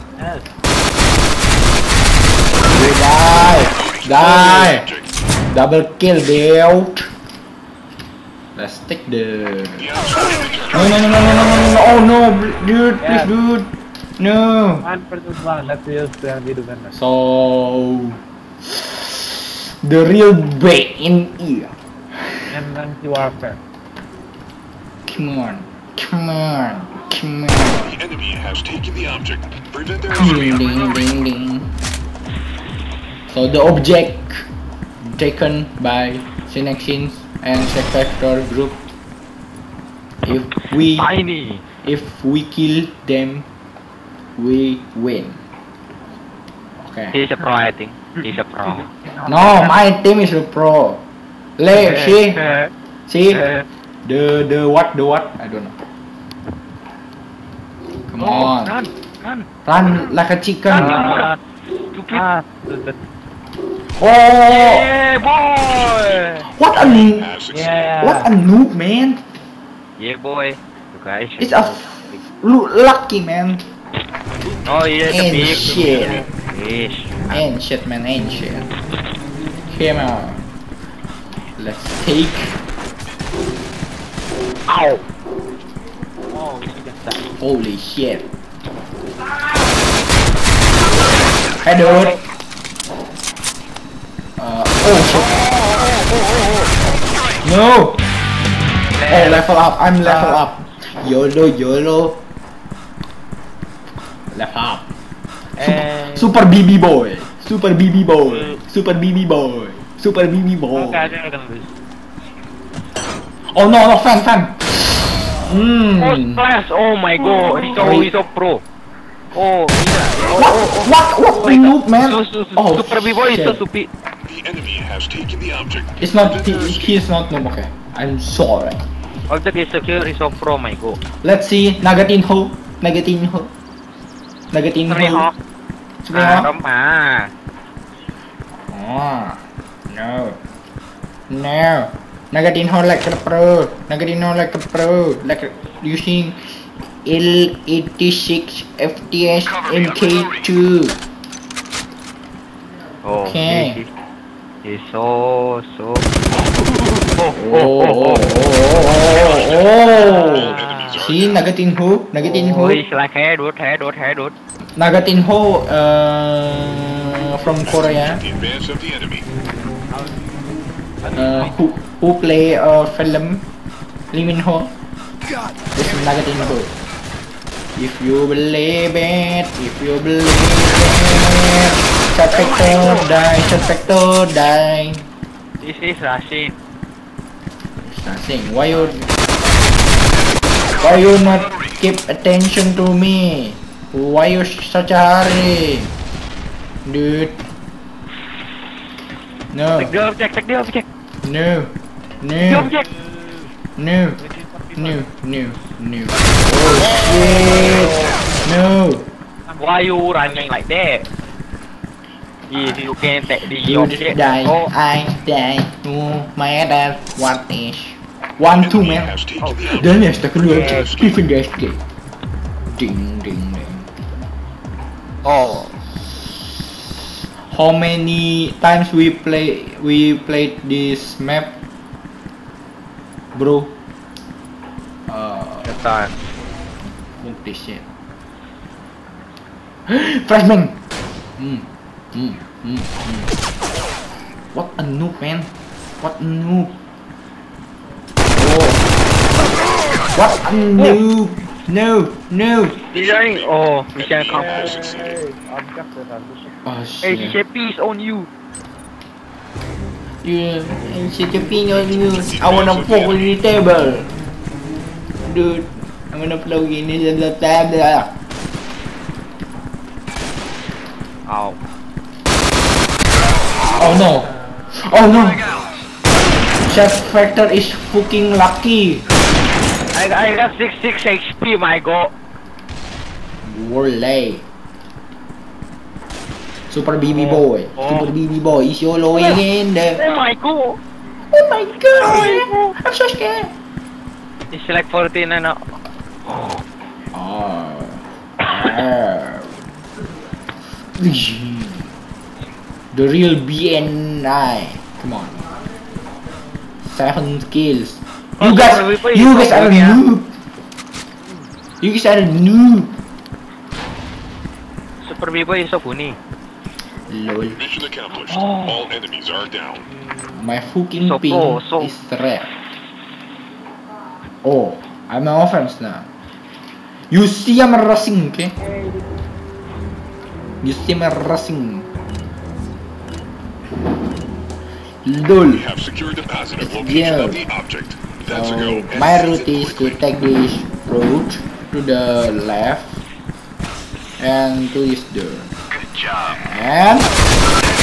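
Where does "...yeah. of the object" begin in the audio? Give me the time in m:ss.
5:36.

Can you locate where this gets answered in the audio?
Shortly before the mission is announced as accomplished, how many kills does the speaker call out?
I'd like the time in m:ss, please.
5:06.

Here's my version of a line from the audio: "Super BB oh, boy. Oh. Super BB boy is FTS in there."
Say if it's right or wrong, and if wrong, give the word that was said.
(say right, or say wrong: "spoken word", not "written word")
wrong: "YOLOing", not "FTS".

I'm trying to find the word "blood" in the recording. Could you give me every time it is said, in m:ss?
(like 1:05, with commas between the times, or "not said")
not said.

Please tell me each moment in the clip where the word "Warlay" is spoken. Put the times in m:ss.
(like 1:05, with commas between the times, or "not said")
4:43.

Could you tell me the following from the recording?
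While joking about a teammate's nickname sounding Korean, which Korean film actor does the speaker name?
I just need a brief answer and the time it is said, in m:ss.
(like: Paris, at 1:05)
Lee Min Ho, at 2:54.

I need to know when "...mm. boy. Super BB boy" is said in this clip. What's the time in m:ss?
1:48.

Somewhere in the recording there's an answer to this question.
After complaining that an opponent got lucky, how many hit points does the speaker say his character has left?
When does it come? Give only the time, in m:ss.
4:40.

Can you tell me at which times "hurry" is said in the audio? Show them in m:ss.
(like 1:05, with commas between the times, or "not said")
3:14.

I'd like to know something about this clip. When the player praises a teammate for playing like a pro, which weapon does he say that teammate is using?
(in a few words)
L86 FTS MK2.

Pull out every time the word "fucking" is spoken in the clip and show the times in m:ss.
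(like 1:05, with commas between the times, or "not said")
4:37, 5:20.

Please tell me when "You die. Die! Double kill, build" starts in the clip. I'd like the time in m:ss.
0:02.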